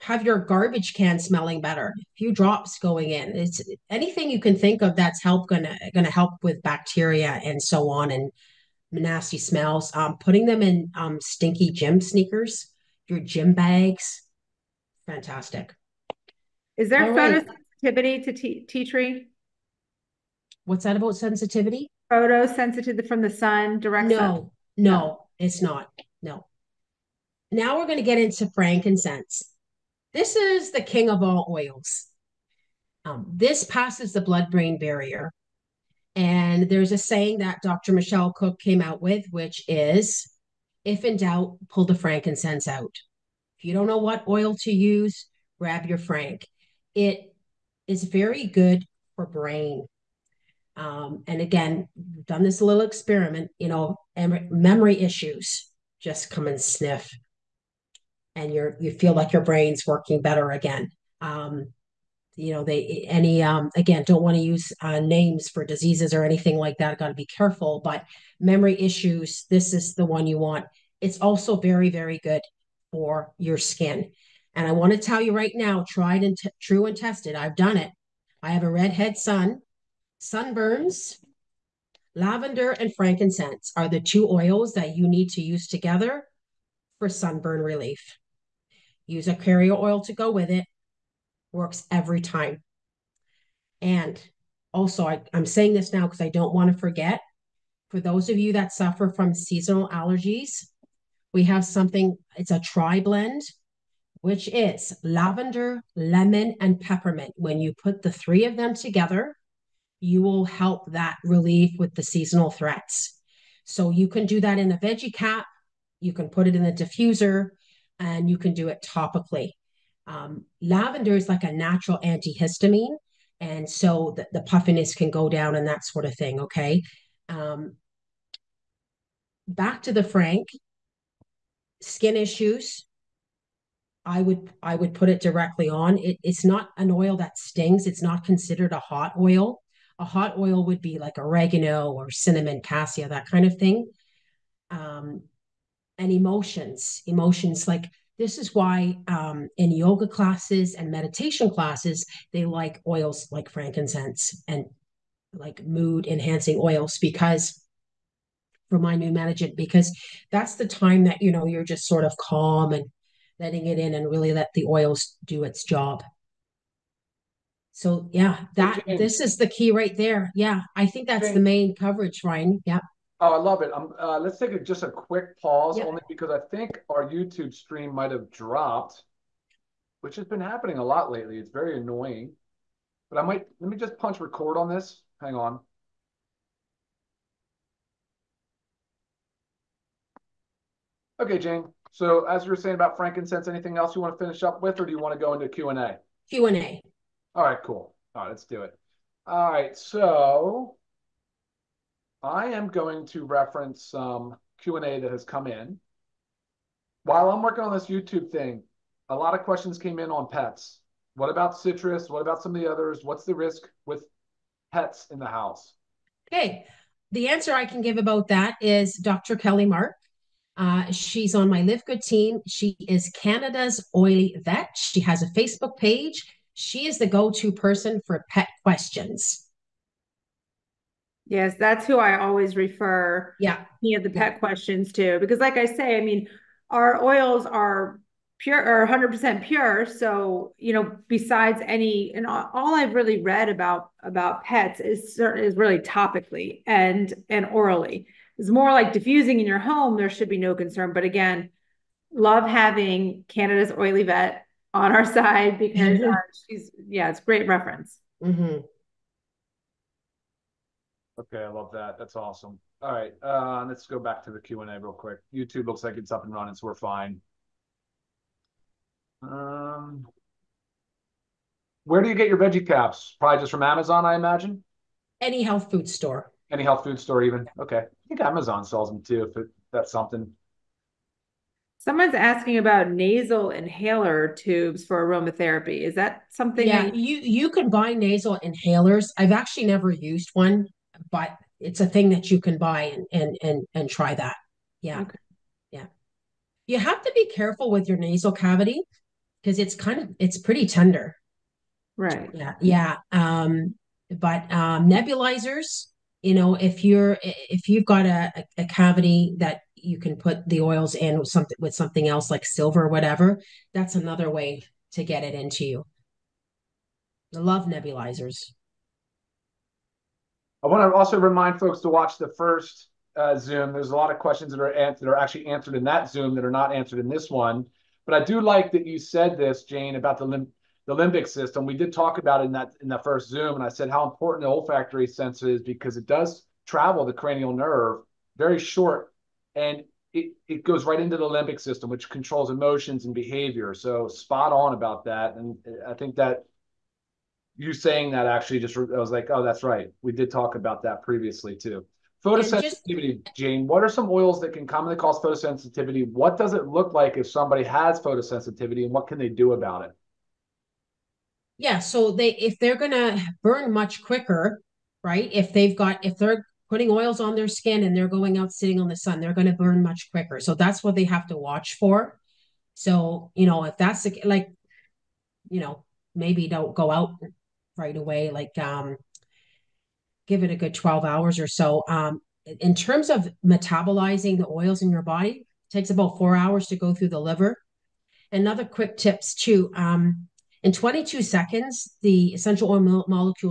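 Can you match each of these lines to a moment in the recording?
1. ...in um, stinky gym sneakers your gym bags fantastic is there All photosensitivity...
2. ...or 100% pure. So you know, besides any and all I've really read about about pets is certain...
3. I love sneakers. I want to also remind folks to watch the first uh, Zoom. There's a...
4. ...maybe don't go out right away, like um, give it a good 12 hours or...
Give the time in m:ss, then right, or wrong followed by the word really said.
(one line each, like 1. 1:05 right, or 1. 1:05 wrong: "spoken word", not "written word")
1. 0:10 right
2. 3:58 right
3. 5:17 wrong: "nebulizers", not "sneakers"
4. 6:16 right.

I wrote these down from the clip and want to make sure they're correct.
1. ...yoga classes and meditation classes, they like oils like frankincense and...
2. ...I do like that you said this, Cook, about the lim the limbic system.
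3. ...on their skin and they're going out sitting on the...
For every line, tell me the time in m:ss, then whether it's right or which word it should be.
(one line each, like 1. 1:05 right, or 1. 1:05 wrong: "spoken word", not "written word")
1. 2:29 right
2. 5:28 wrong: "Jane", not "Cook"
3. 6:07 right.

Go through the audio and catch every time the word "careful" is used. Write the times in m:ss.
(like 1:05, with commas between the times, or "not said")
1:07, 4:57.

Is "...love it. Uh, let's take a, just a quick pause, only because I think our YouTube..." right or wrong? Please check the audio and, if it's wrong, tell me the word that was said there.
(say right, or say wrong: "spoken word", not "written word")
right.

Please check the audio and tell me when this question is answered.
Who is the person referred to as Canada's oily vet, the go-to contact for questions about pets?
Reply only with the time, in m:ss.
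3:38.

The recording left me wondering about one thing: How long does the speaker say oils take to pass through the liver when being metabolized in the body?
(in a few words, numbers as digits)
4 hours.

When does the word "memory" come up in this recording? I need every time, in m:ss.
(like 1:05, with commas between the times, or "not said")
0:54, 1:08.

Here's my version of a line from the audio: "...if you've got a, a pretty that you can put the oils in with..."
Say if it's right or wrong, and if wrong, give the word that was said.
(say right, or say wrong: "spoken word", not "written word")
wrong: "cavity", not "pretty".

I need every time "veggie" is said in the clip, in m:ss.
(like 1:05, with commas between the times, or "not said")
1:54, 4:32.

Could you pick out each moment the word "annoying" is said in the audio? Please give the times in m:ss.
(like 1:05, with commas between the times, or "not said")
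3:01.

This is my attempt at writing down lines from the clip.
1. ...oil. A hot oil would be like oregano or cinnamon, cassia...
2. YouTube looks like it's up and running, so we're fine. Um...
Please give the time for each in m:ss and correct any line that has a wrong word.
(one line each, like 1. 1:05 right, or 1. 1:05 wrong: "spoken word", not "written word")
1. 2:19 right
2. 4:25 right.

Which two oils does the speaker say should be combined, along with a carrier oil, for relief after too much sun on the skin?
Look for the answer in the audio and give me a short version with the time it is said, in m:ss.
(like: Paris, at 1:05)
Lavender and frankincense, at 1:22.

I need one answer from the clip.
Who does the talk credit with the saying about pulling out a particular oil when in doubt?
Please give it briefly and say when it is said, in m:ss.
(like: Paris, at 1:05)
Dr. Michelle Cook, at 0:37.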